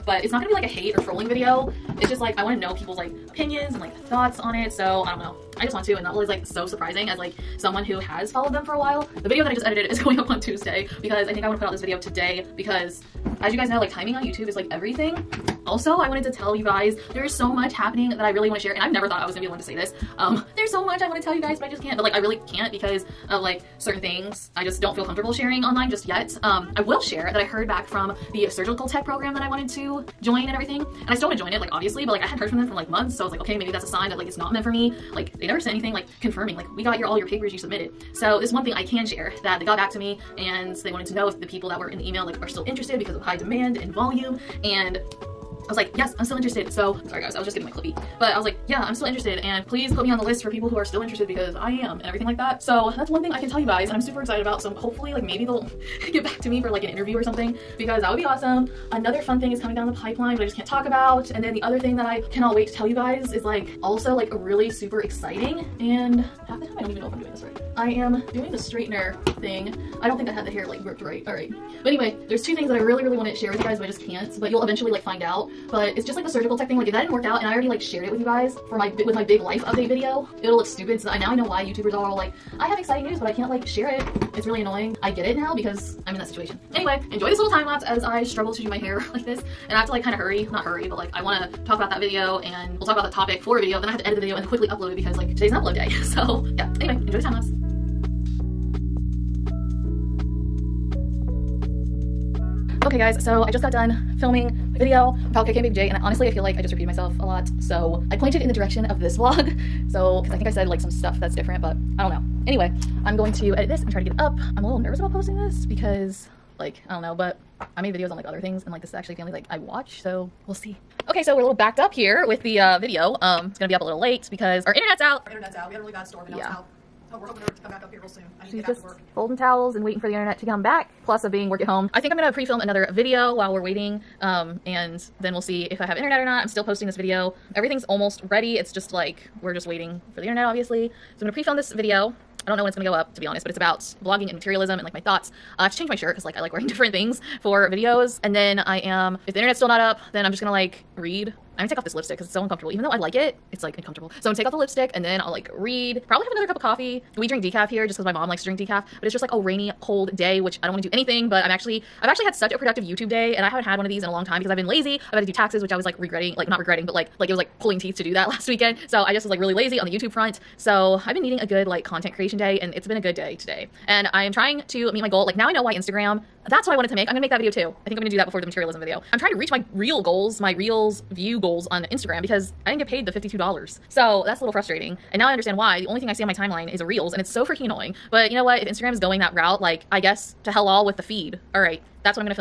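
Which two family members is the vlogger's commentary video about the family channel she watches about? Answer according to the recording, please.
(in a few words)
KK and Baby J.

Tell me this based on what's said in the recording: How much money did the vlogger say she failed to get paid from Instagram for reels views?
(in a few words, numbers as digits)
$52.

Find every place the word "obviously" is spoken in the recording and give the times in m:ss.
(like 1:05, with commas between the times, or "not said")
0:31, 2:20.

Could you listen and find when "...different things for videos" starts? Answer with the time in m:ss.
2:26.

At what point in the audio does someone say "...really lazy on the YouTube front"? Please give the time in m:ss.
2:49.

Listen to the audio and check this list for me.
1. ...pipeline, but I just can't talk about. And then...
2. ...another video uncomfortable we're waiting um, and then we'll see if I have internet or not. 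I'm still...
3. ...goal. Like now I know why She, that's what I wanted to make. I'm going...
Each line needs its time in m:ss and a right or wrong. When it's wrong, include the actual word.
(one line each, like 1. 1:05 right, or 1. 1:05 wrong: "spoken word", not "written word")
1. 0:59 right
2. 2:12 wrong: "while", not "uncomfortable"
3. 2:55 wrong: "Instagram", not "She".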